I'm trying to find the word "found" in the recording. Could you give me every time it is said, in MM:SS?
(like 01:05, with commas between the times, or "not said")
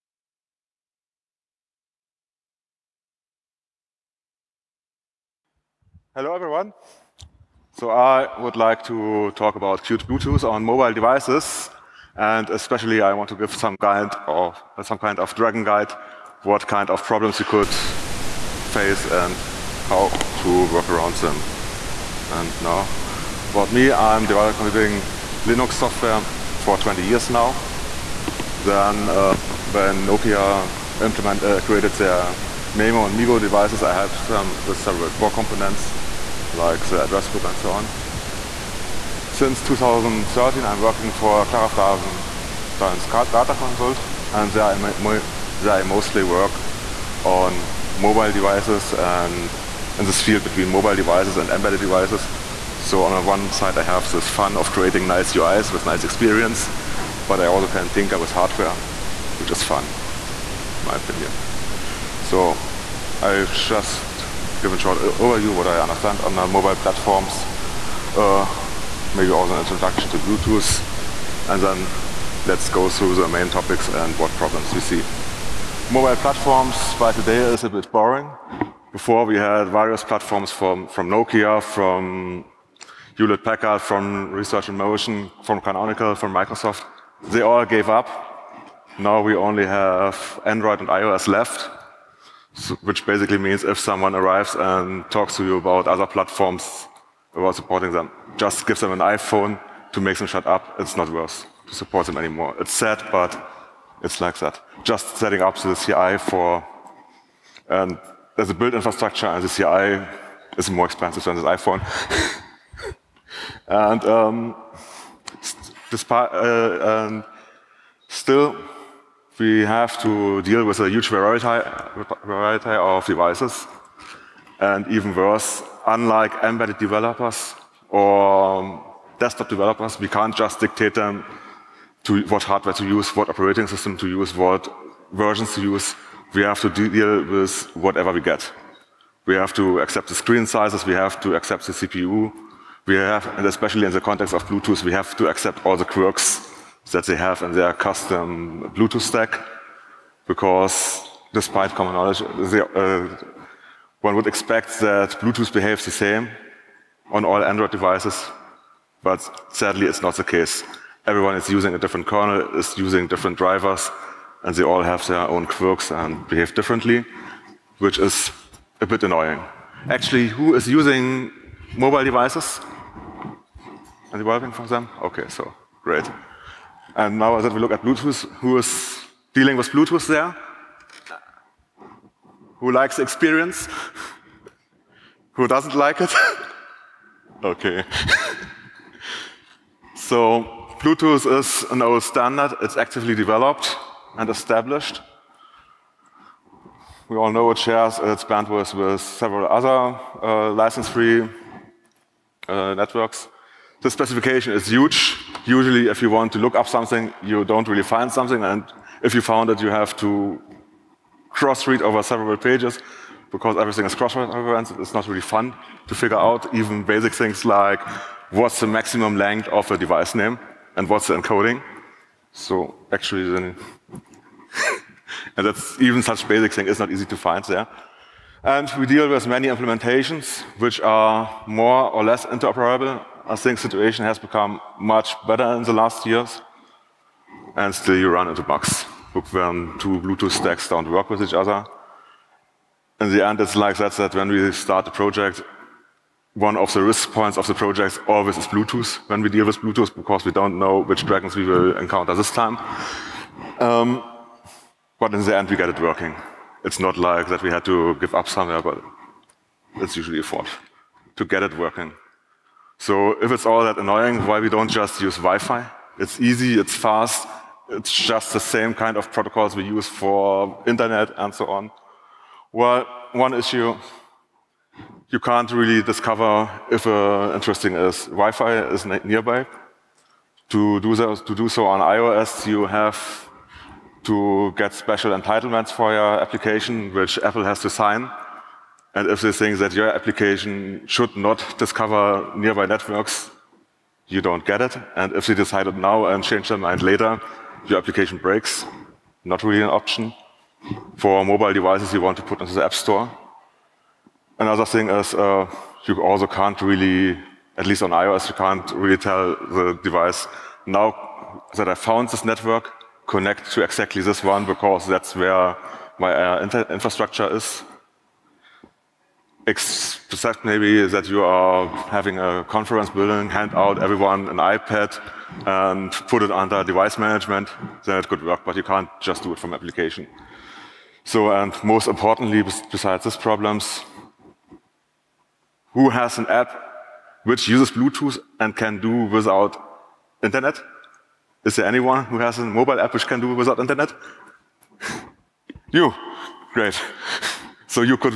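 03:29, 05:11.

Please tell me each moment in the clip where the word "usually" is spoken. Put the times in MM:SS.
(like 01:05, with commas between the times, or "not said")
03:25, 04:19.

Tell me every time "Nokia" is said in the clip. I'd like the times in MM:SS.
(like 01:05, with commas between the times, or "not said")
00:30, 01:21.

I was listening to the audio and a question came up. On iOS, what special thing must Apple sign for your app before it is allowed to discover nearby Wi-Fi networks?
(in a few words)
entitlements.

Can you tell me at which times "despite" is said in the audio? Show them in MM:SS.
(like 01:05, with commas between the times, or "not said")
01:55, 02:31.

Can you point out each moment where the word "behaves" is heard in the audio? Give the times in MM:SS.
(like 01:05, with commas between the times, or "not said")
02:35, 02:46.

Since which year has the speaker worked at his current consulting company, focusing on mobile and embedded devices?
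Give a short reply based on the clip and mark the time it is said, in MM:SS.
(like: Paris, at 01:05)
2013, at 00:39.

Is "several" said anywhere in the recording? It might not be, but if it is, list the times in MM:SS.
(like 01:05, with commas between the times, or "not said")
00:34, 03:18, 03:32.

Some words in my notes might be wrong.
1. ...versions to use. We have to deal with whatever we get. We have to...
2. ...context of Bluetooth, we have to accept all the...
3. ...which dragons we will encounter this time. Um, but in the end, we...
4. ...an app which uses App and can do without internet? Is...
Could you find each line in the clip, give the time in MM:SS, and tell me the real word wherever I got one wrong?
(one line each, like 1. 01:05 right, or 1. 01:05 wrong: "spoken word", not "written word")
1. 02:15 right
2. 02:23 right
3. 04:10 right
4. 05:36 wrong: "Bluetooth", not "App".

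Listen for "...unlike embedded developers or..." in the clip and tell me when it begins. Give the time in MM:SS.
02:05.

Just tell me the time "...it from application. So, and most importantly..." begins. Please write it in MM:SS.
05:29.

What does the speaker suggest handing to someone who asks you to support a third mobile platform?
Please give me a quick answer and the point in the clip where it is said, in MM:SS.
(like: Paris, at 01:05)
an iPhone, at 01:38.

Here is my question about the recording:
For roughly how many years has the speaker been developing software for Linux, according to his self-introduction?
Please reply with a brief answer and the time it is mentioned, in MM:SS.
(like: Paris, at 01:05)
20, at 00:26.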